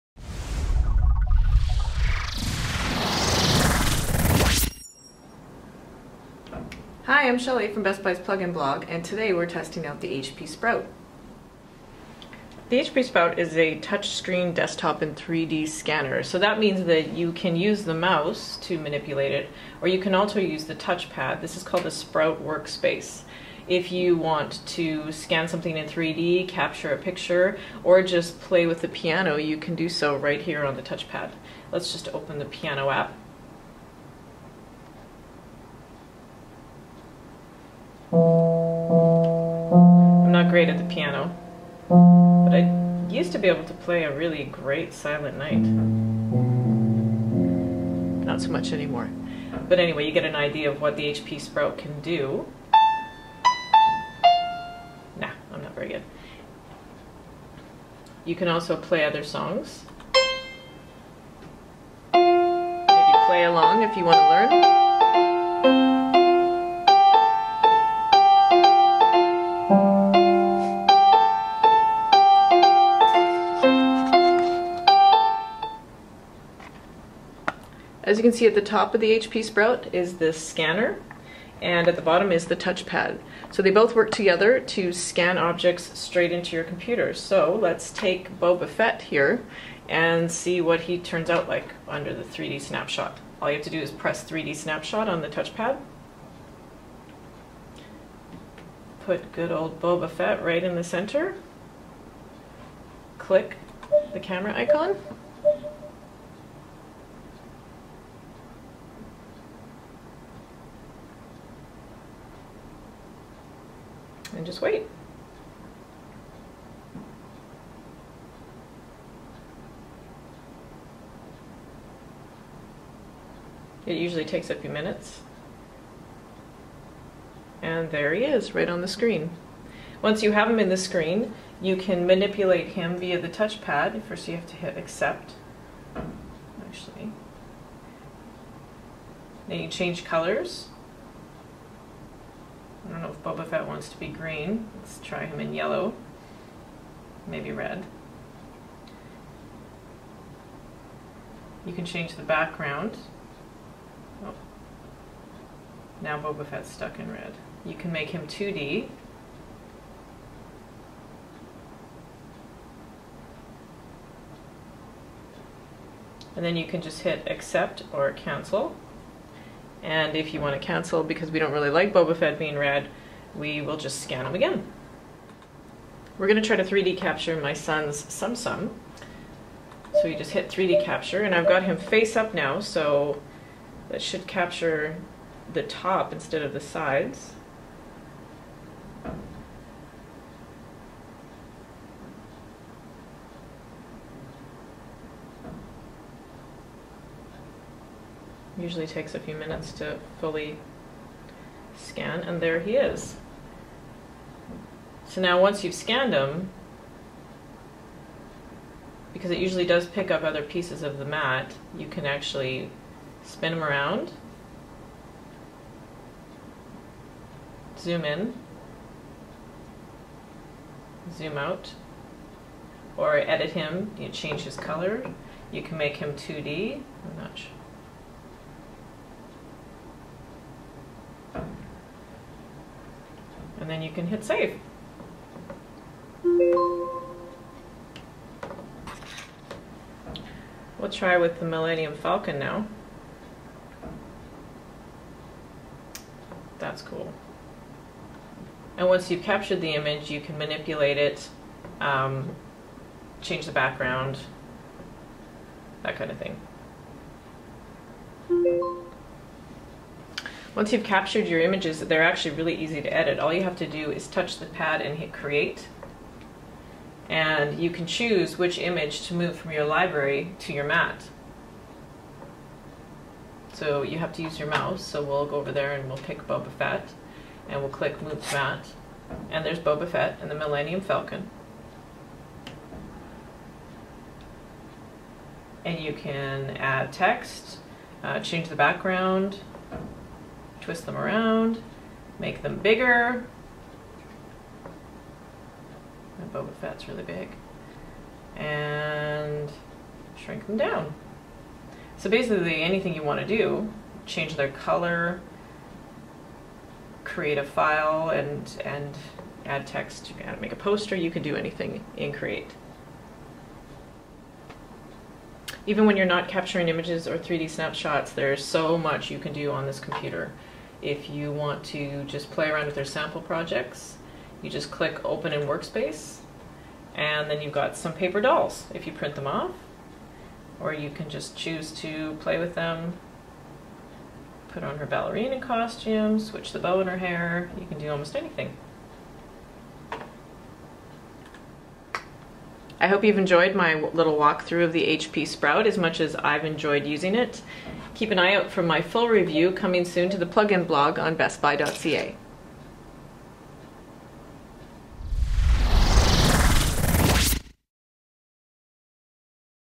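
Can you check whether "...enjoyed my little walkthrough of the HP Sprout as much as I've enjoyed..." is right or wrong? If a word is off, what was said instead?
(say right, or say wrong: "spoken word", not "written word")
right.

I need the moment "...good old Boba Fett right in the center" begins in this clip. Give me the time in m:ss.
1:39.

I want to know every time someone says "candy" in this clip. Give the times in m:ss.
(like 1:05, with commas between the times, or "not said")
not said.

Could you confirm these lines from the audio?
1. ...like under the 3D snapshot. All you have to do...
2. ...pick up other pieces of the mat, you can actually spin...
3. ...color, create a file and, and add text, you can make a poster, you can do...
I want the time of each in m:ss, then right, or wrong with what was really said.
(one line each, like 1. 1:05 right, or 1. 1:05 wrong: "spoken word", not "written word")
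1. 1:31 right
2. 3:29 right
3. 5:04 right.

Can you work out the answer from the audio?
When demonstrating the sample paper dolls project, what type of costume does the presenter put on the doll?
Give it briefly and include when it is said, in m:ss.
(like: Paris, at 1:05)
ballerina, at 5:34.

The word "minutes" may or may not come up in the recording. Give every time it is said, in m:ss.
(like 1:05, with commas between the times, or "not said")
2:04, 3:19.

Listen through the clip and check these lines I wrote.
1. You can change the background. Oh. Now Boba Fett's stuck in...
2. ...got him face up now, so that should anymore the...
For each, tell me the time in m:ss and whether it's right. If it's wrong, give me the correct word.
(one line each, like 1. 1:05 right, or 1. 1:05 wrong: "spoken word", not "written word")
1. 2:31 right
2. 3:01 wrong: "capture", not "anymore".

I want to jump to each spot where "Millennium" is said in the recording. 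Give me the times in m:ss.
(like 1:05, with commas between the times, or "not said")
4:01, 4:40.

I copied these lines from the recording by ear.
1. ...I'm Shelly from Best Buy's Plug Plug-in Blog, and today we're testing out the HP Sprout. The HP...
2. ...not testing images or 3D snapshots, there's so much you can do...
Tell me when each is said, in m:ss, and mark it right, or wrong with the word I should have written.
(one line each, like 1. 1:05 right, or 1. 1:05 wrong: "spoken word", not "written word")
1. 0:07 right
2. 5:16 wrong: "capturing", not "testing".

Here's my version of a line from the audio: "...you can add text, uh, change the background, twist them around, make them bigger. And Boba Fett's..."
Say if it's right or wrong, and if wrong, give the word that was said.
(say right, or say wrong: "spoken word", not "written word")
right.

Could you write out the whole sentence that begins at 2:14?
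First you have to hit accept, actually.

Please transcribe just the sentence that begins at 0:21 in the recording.
This is called the Sprout Workspace.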